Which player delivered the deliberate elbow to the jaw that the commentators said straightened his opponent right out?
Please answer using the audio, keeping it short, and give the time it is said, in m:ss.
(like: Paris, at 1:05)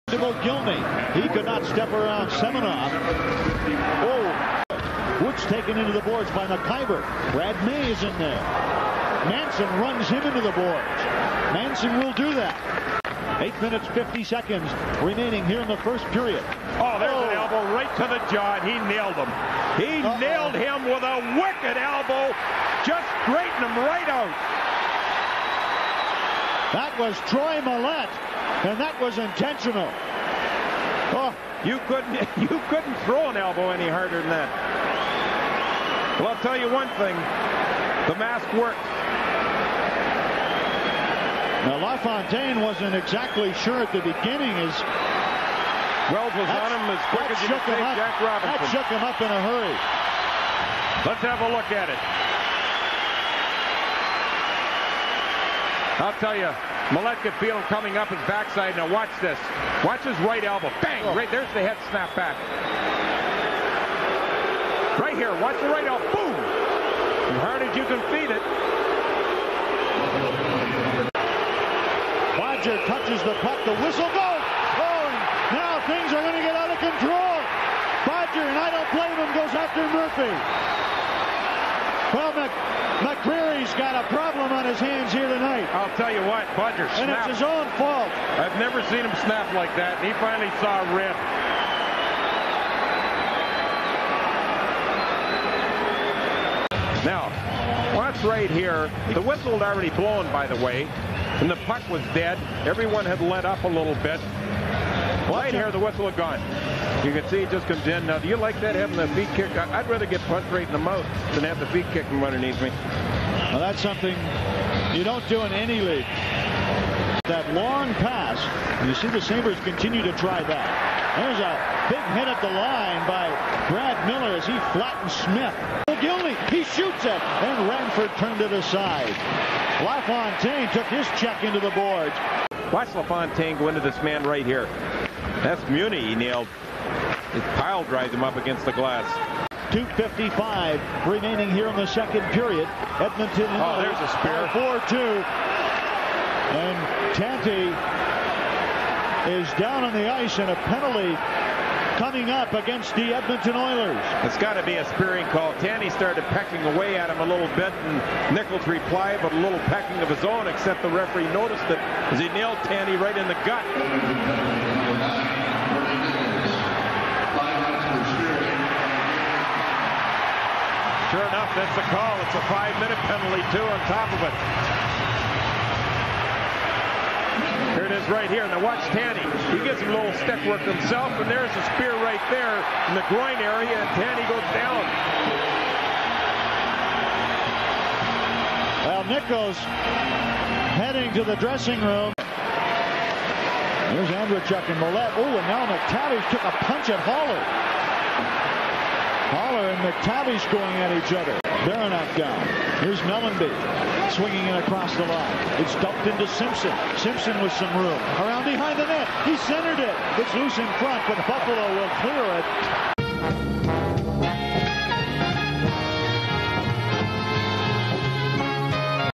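Troy Mallette, at 0:27.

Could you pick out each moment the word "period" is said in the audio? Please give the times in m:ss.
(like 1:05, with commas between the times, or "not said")
0:16, 2:22.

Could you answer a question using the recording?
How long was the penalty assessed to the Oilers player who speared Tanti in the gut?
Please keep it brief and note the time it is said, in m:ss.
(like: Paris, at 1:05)
5 minutes, at 2:52.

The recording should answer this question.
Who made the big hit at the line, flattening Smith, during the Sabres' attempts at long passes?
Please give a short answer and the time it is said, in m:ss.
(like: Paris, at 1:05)
Brad Miller, at 2:03.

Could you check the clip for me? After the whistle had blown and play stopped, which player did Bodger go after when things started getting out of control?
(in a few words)
Murphy.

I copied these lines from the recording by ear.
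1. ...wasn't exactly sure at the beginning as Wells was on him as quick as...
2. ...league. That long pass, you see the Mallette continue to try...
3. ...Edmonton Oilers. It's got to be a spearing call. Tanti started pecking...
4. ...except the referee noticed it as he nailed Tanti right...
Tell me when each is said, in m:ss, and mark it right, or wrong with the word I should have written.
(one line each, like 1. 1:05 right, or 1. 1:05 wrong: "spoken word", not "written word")
1. 0:42 right
2. 1:55 wrong: "Sabres", not "Mallette"
3. 2:33 right
4. 2:40 right.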